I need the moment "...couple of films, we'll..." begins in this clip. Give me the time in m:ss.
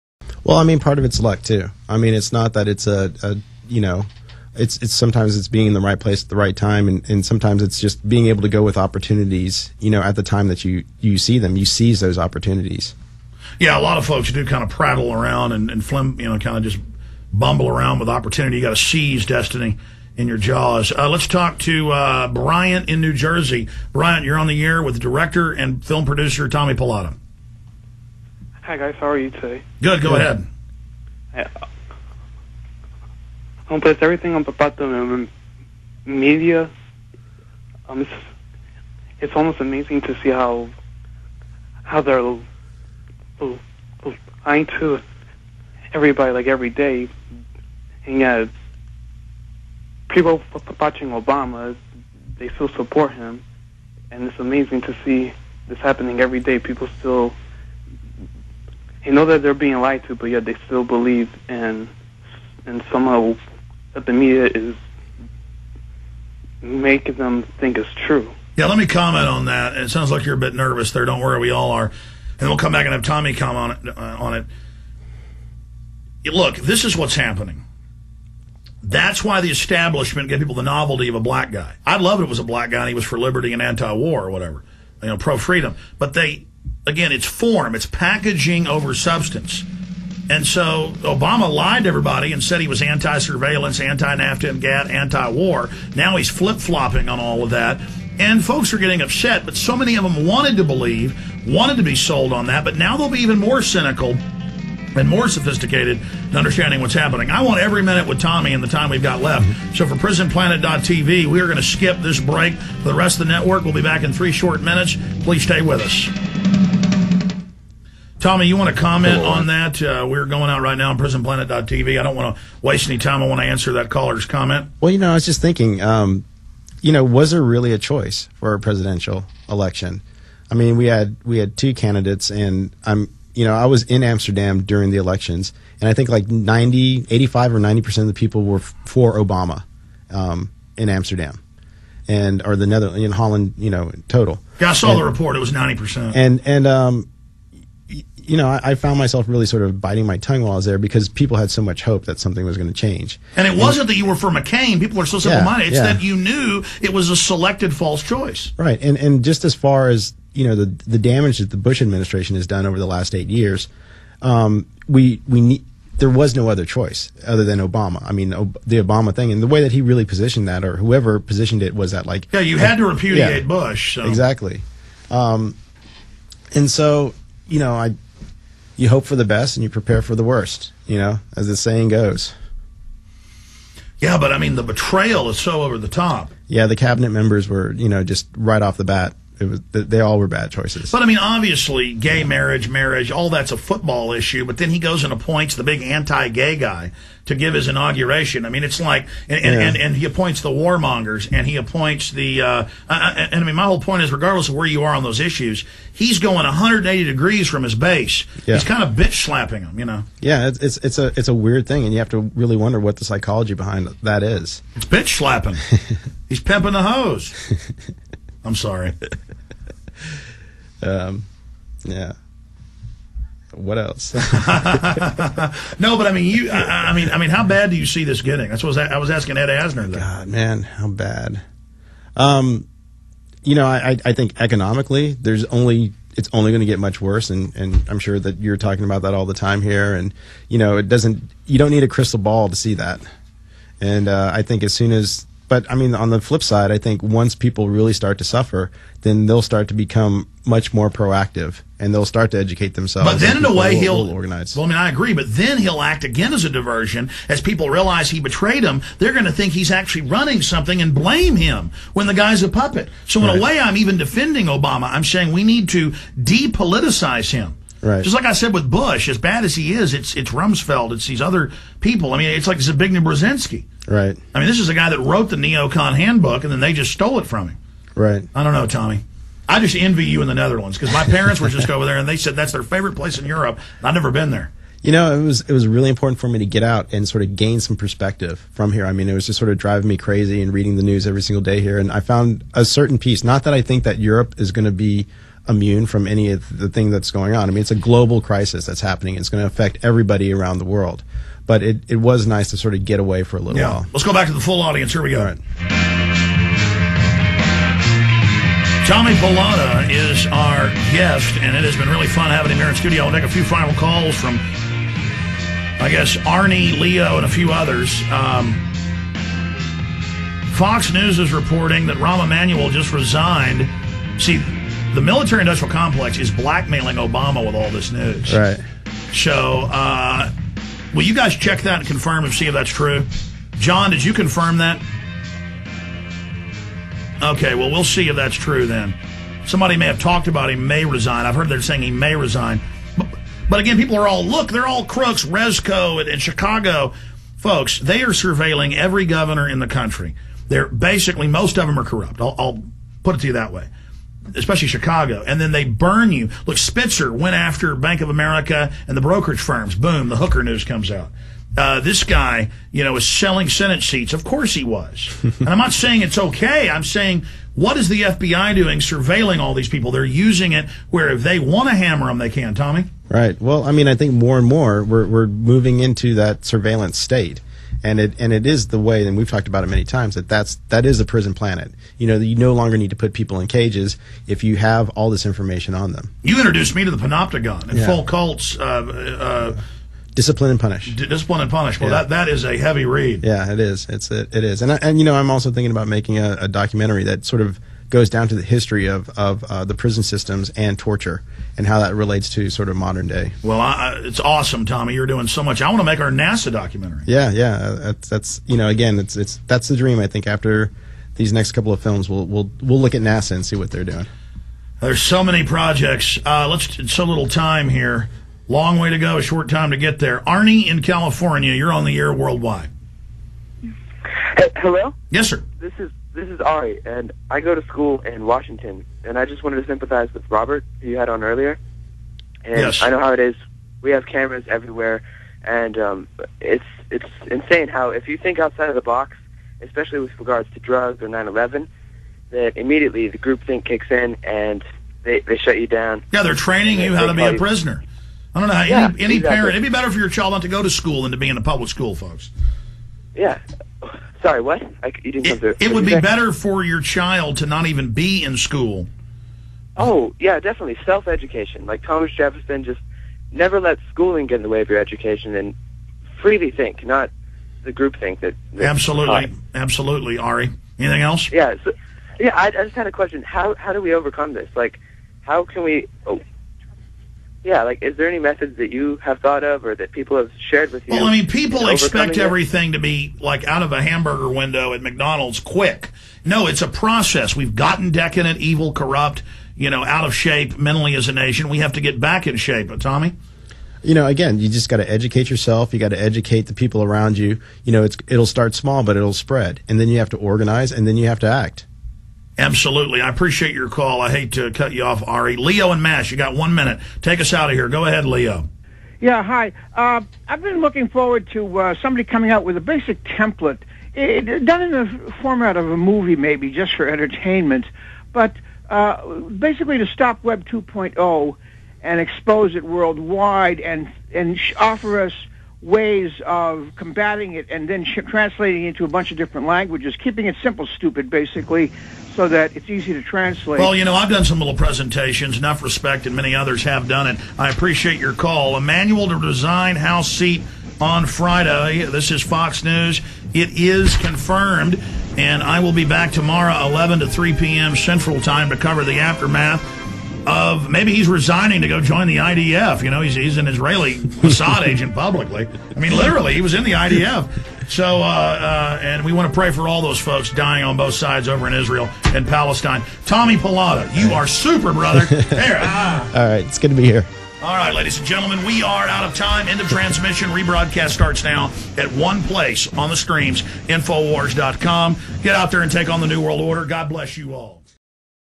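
6:51.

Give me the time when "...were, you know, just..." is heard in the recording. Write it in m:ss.
3:07.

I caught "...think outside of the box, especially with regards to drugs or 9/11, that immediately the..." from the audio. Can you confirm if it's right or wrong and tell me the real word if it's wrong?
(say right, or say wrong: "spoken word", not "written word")
right.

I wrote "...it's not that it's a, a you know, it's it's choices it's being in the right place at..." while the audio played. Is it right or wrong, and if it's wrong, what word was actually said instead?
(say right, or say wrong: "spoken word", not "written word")
wrong: "sometimes", not "choices".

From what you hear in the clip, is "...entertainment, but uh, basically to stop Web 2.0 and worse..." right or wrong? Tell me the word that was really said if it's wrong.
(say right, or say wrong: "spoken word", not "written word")
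wrong: "expose", not "worse".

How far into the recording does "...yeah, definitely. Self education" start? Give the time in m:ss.
7:40.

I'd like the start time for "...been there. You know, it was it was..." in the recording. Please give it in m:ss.
4:44.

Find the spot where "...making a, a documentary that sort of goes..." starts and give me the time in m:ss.
6:35.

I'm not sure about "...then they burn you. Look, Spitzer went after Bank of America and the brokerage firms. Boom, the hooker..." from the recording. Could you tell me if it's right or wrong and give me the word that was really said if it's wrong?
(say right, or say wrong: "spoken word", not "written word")
right.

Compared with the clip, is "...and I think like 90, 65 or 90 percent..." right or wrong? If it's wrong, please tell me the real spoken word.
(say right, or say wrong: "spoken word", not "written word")
wrong: "85", not "65".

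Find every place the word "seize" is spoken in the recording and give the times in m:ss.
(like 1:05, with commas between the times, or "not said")
0:11, 0:18.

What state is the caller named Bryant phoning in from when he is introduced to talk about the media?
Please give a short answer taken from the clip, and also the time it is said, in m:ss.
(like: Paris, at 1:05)
New Jersey, at 0:22.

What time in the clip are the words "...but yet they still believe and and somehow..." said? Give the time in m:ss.
1:00.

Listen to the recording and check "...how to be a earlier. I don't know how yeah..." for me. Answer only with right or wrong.
wrong.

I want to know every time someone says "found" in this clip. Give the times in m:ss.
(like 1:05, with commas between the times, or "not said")
2:28, 4:51.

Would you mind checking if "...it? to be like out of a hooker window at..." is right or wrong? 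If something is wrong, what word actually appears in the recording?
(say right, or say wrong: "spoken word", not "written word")
wrong: "hamburger", not "hooker".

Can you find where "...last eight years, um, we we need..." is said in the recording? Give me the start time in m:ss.
2:42.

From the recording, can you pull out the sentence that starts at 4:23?
a way, I'm even defending Obama.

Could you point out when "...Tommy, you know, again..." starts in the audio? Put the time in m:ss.
8:12.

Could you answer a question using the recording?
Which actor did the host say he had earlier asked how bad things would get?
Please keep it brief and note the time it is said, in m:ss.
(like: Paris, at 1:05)
Ed Asner, at 3:49.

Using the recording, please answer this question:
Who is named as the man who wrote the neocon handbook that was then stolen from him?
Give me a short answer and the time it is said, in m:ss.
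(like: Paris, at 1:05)
Zbigniew Brzezinski, at 4:32.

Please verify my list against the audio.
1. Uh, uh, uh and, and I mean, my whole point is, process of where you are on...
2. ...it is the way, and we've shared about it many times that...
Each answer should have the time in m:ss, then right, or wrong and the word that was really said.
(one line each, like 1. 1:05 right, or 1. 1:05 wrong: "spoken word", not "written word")
1. 3:22 wrong: "regardless", not "process"
2. 6:18 wrong: "talked", not "shared".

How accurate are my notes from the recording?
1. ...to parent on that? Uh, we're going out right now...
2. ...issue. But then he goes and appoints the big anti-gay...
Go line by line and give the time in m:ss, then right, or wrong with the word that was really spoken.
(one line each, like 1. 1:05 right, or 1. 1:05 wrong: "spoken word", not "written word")
1. 1:58 wrong: "comment", not "parent"
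2. 3:14 right.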